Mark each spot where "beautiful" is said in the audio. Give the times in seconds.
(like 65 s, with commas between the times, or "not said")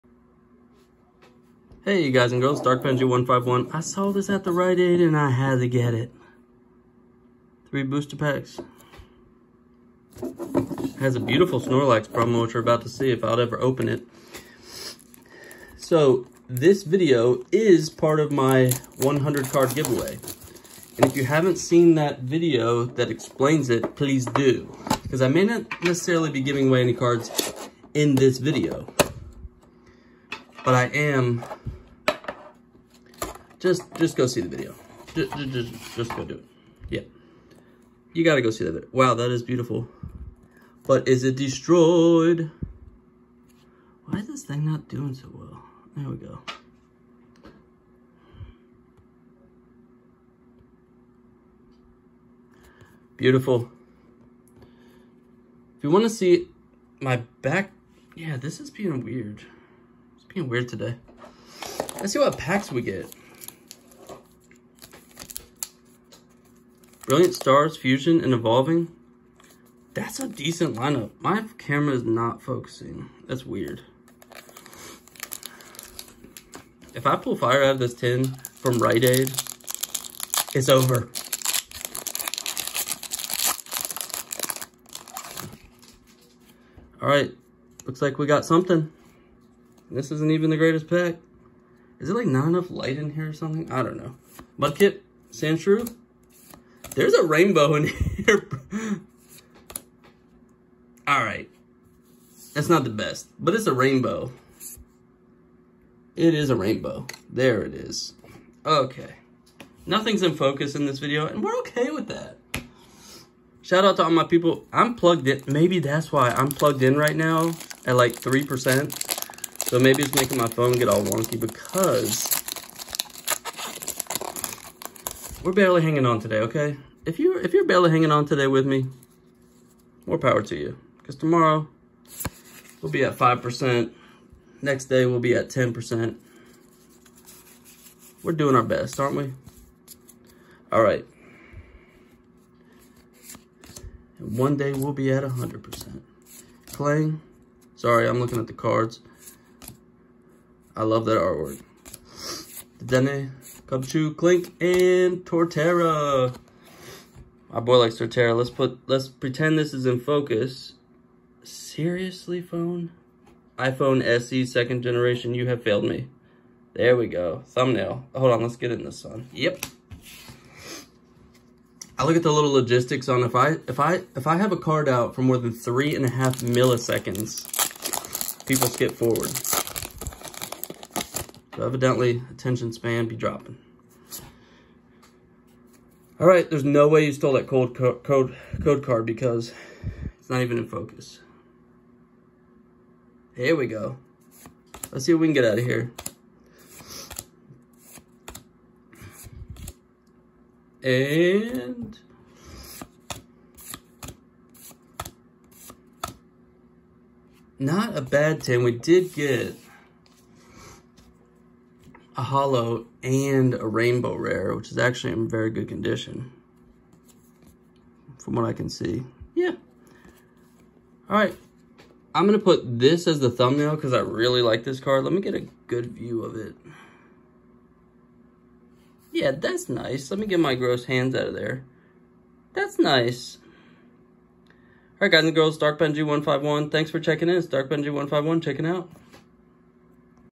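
11 s, 39 s, 53 s.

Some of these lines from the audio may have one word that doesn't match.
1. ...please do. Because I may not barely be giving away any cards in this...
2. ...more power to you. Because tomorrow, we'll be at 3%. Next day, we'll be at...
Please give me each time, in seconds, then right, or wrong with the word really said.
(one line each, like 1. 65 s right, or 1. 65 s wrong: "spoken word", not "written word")
1. 23 s wrong: "necessarily", not "barely"
2. 130 s wrong: "5", not "3".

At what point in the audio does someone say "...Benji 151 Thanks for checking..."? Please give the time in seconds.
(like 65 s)
235 s.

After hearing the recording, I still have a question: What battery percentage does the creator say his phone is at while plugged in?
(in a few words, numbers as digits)
3%.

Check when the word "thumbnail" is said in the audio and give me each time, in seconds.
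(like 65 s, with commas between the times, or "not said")
167 s, 223 s.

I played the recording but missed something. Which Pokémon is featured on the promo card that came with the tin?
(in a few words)
Snorlax.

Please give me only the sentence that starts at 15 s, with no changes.
So, this video is part of my 100 card giveaway.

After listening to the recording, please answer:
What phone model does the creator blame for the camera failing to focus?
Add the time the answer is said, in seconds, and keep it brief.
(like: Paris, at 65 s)
iPhone SE second generation, at 163 s.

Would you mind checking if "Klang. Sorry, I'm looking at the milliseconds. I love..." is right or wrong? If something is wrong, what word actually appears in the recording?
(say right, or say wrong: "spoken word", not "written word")
wrong: "cards", not "milliseconds".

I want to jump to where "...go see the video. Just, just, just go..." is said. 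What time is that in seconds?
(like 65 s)
34 s.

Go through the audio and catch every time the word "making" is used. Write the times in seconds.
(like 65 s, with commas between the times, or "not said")
120 s.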